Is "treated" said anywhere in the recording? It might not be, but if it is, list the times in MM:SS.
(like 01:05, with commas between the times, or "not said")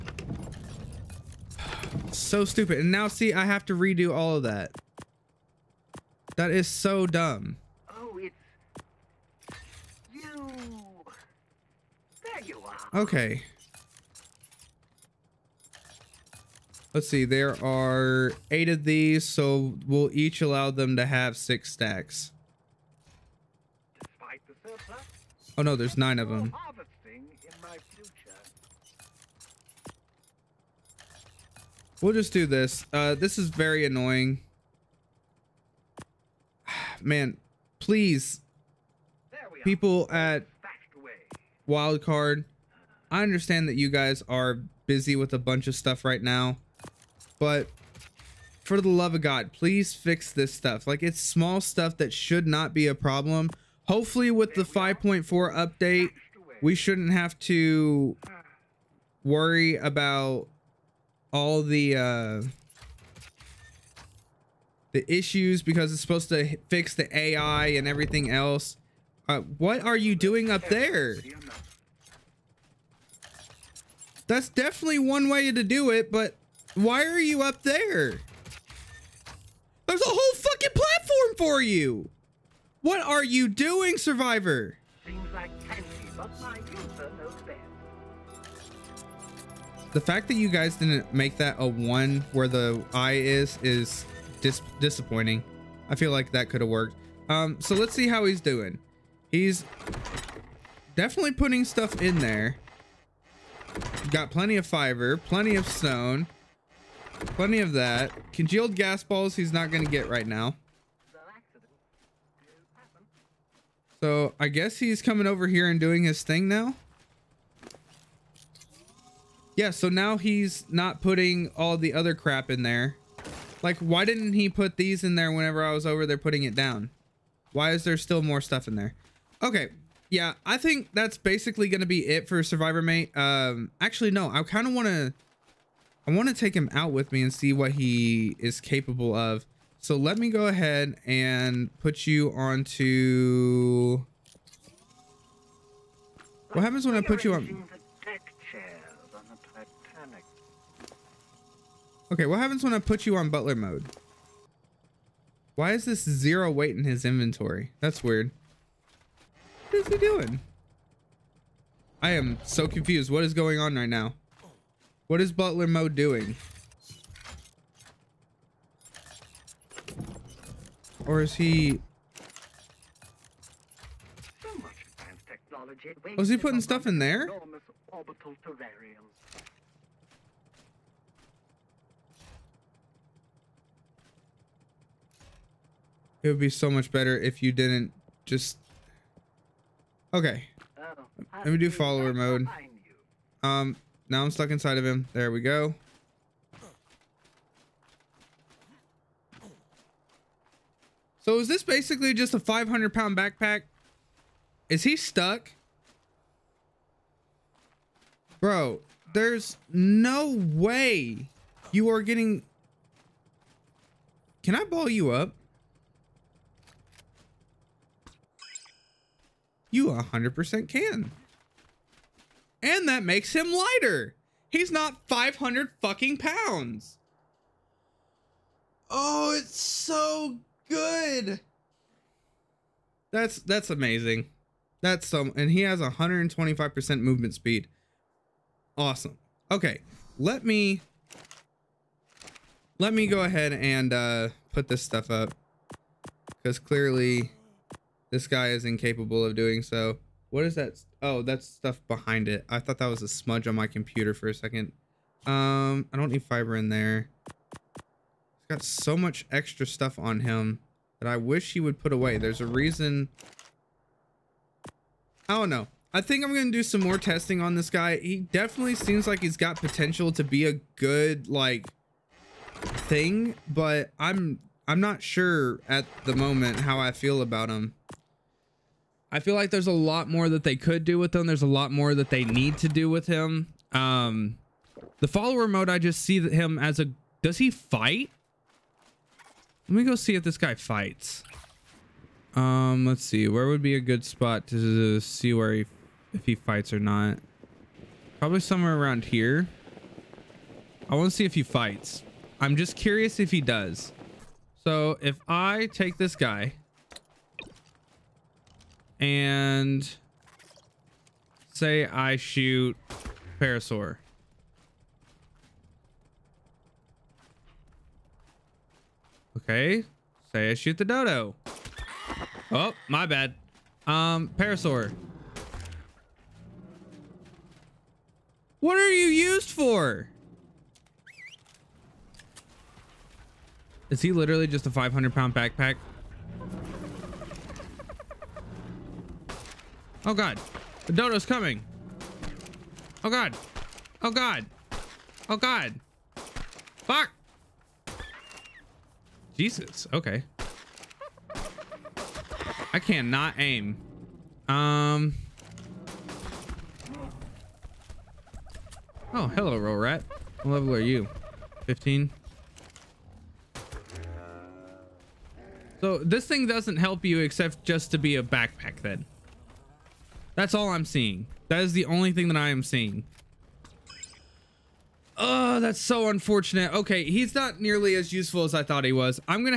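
not said.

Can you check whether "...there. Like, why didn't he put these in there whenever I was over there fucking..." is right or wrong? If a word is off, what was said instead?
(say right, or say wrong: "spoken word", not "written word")
wrong: "putting", not "fucking".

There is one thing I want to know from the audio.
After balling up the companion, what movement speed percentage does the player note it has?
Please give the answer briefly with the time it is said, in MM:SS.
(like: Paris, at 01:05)
125%, at 03:55.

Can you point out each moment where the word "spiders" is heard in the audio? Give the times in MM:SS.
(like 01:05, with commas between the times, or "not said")
not said.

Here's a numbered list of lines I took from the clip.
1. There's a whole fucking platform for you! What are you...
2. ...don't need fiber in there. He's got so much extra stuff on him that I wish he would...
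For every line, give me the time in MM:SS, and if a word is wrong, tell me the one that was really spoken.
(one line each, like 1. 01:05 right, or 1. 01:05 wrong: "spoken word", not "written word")
1. 01:19 right
2. 04:15 right.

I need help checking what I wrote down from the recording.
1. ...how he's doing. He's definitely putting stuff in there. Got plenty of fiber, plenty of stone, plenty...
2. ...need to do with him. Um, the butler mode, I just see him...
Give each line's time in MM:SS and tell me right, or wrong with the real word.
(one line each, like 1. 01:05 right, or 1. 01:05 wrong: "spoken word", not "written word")
1. 01:38 right
2. 04:42 wrong: "follower", not "butler".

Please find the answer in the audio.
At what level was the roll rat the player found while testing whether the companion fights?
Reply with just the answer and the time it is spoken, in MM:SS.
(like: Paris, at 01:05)
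15, at 06:01.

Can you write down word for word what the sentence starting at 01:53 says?
So I guess he's coming over here and doing his thing now.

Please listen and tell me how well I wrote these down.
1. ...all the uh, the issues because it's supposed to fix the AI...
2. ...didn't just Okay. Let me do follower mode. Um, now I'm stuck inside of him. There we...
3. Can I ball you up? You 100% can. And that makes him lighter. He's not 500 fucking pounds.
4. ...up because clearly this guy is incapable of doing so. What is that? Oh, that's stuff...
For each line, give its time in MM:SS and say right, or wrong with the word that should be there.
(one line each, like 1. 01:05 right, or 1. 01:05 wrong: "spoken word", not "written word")
1. 01:01 right
2. 03:07 right
3. 03:34 right
4. 04:05 right.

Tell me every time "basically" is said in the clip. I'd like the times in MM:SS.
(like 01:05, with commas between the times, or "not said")
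02:11, 03:21.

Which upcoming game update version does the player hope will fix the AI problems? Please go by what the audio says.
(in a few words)
5.4.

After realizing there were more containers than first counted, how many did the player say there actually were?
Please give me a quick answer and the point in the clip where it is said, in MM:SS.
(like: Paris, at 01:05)
9, at 00:25.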